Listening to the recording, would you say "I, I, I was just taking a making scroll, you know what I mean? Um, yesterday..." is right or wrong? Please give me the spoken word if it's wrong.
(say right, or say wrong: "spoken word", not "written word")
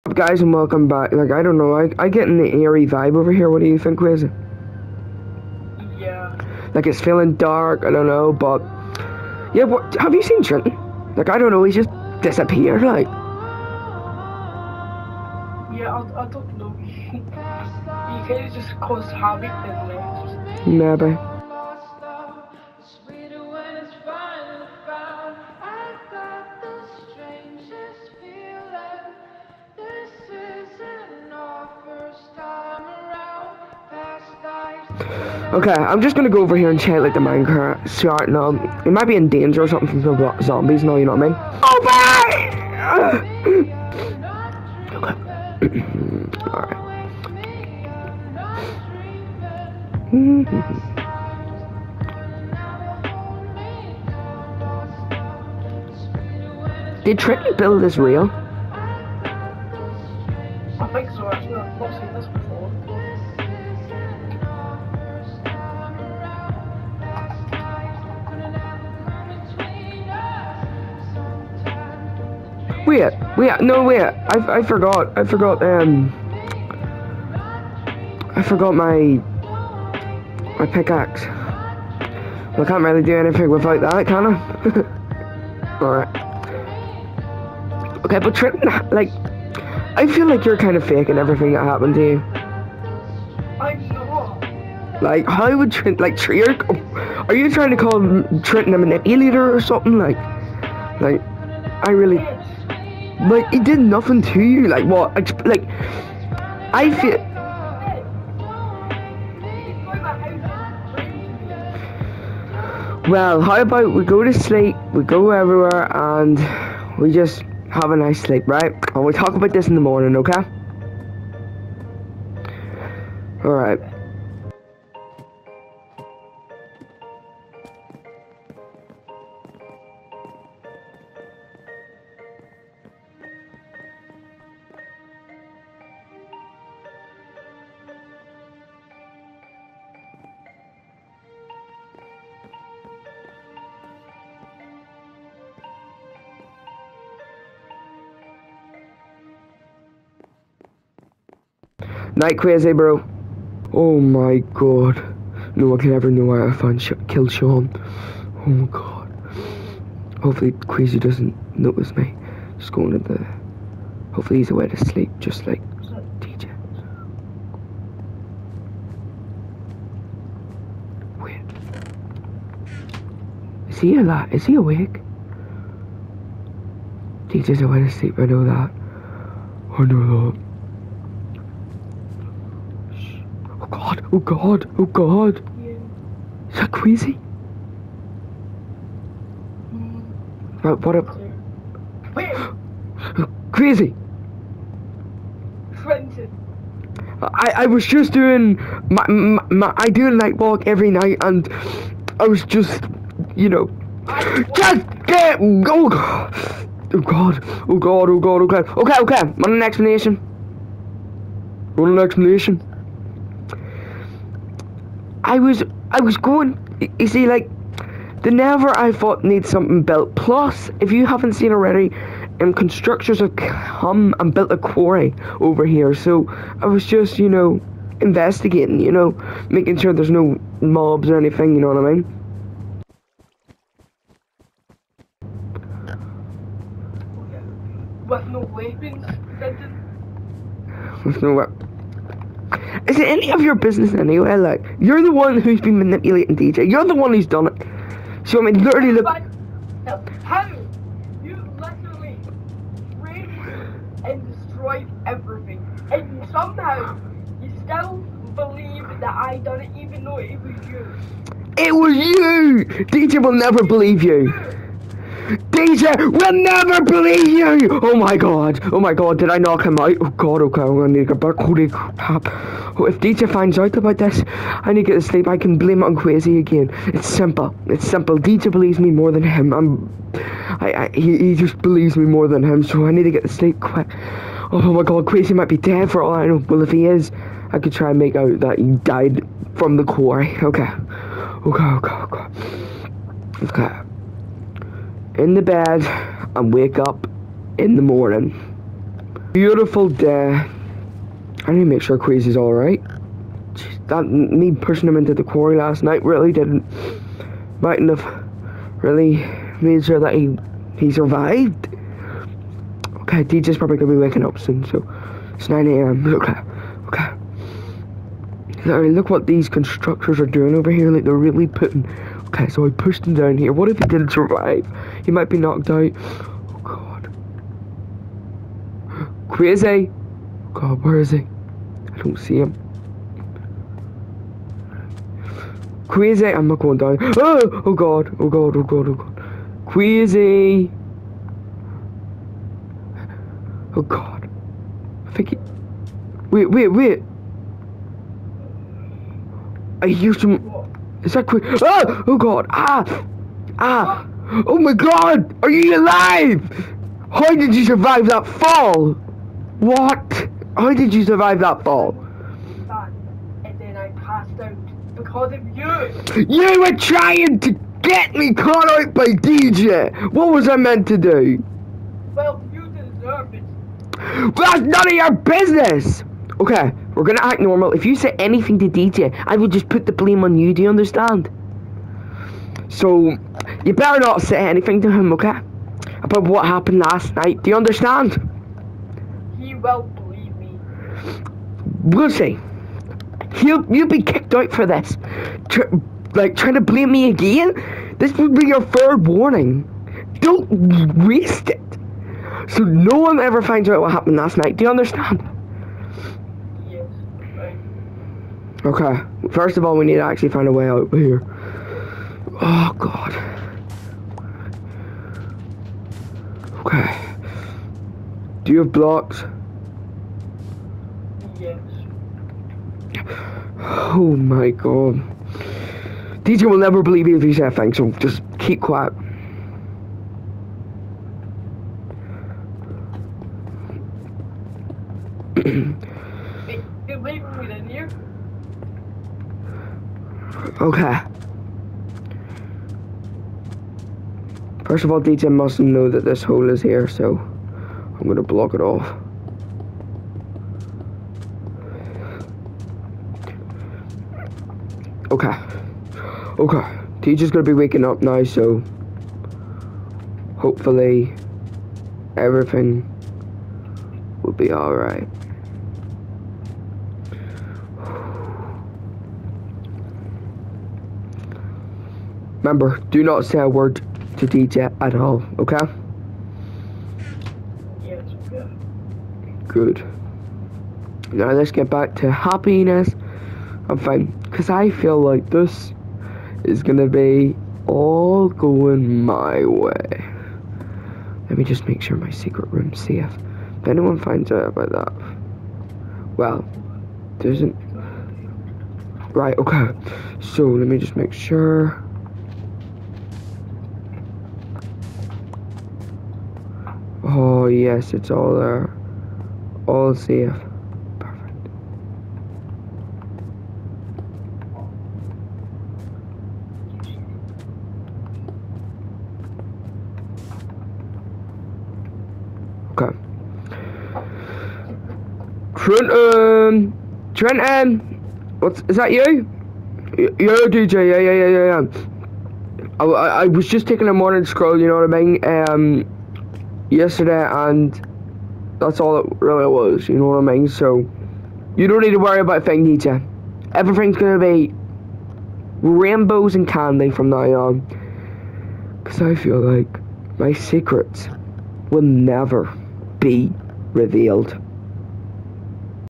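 wrong: "morning", not "making".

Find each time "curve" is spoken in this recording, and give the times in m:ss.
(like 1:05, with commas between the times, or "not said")
not said.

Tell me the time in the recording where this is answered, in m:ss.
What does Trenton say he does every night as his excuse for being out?
3:20.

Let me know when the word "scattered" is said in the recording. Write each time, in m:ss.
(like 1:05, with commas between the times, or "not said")
not said.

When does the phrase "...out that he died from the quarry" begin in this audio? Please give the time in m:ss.
4:48.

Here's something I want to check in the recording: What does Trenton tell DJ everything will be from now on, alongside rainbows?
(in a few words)
Candy.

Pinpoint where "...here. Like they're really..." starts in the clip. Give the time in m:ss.
5:20.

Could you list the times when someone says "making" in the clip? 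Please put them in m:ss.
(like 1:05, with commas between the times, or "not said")
3:49.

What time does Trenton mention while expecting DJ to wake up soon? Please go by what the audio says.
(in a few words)
9 a.m.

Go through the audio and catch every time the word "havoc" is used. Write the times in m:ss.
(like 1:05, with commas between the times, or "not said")
0:19.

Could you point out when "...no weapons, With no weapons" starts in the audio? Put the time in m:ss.
3:58.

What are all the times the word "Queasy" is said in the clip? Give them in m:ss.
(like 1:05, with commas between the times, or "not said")
2:40, 5:01.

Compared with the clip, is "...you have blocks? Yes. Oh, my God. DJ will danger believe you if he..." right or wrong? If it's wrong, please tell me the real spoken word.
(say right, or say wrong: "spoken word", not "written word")
wrong: "never", not "danger".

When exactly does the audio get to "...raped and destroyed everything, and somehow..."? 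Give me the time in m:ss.
4:12.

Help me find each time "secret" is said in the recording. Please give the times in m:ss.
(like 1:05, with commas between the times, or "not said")
8:12, 9:10.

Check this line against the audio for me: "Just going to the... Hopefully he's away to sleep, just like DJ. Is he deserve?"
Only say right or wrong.
wrong.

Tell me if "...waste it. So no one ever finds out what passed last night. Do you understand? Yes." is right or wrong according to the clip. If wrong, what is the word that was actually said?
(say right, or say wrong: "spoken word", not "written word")
wrong: "happened", not "passed".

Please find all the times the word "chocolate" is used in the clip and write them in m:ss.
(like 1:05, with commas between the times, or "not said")
not said.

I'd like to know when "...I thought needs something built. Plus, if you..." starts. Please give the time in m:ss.
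3:38.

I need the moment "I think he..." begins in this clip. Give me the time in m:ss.
5:45.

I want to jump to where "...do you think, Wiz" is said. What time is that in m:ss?
0:03.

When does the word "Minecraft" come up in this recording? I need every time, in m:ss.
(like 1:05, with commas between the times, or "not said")
0:37.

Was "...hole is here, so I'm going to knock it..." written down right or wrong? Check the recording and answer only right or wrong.
wrong.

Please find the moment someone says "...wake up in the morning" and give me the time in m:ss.
4:56.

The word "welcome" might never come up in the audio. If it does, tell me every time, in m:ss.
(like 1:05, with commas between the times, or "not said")
0:00.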